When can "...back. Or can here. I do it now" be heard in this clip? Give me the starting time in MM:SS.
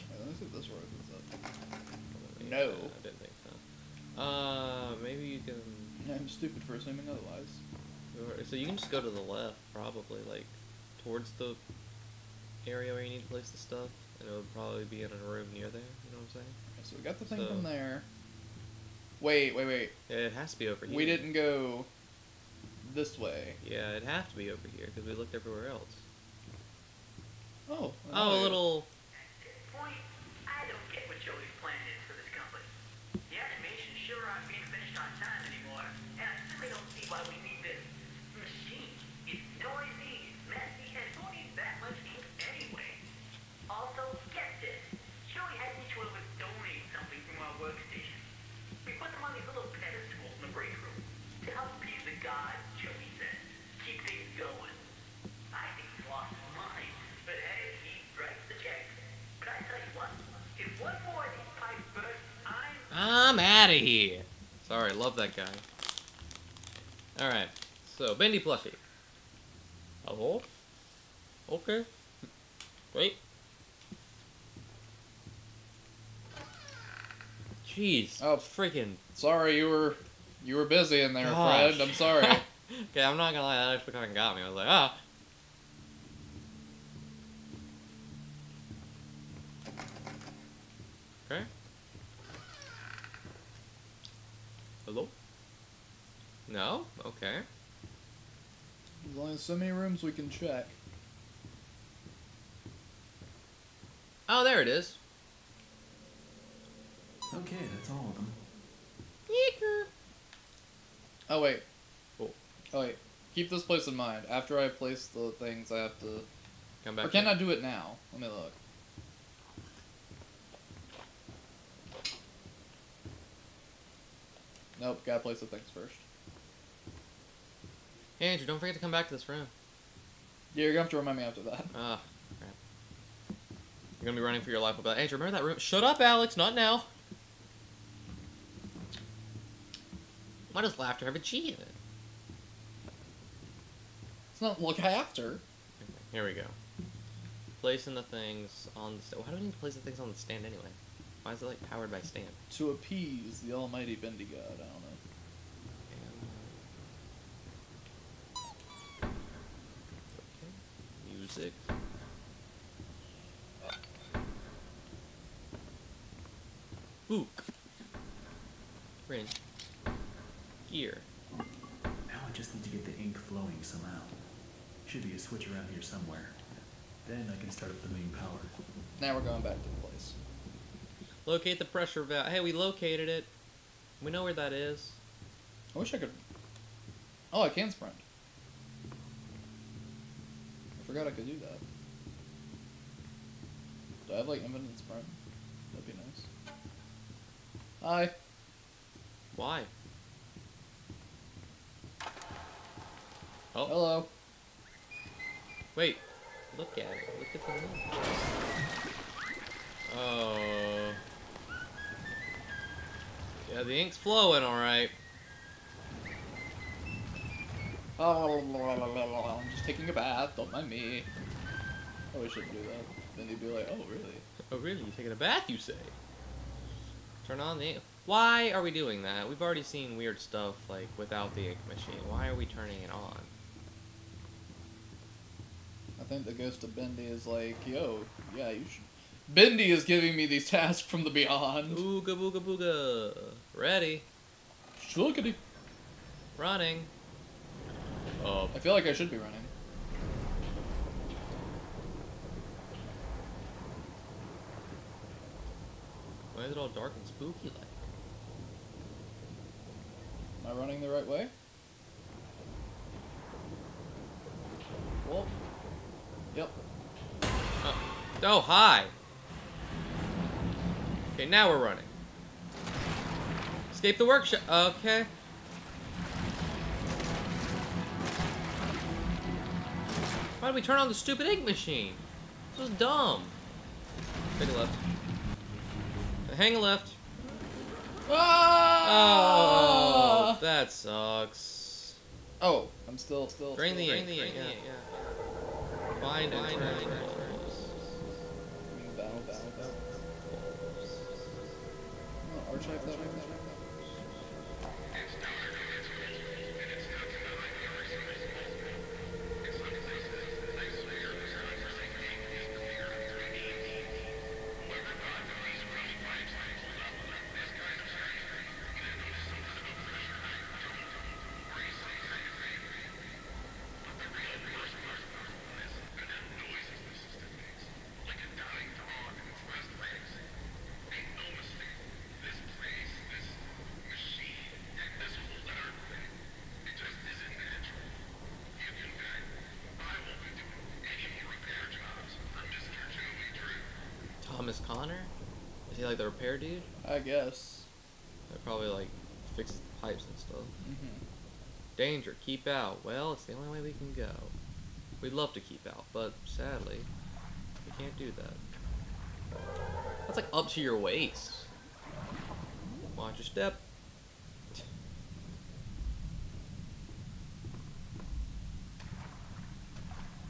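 01:56.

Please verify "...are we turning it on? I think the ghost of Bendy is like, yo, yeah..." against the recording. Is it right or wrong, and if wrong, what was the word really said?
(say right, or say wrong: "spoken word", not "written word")
right.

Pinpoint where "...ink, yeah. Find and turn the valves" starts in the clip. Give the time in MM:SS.
04:53.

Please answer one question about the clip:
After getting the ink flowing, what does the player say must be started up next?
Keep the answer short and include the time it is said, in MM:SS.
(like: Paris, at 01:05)
main power, at 02:57.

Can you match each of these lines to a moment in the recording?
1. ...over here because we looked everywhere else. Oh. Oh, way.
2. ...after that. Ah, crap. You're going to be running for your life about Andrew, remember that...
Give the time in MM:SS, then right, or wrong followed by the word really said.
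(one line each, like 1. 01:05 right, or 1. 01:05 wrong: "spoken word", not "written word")
1. 00:24 right
2. 02:11 right.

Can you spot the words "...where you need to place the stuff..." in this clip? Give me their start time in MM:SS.
00:12.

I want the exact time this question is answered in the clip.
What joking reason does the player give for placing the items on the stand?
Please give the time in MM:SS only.
02:32.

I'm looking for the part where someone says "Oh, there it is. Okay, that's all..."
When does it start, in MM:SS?
01:44.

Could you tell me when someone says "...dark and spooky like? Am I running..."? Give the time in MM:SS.
04:16.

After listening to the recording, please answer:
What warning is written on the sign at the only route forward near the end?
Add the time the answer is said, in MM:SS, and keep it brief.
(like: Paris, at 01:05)
Danger, keep out, at 05:51.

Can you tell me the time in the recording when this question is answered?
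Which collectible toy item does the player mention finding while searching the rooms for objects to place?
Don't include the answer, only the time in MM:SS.
01:08.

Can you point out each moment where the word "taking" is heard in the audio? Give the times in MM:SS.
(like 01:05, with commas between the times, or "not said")
03:39, 03:44.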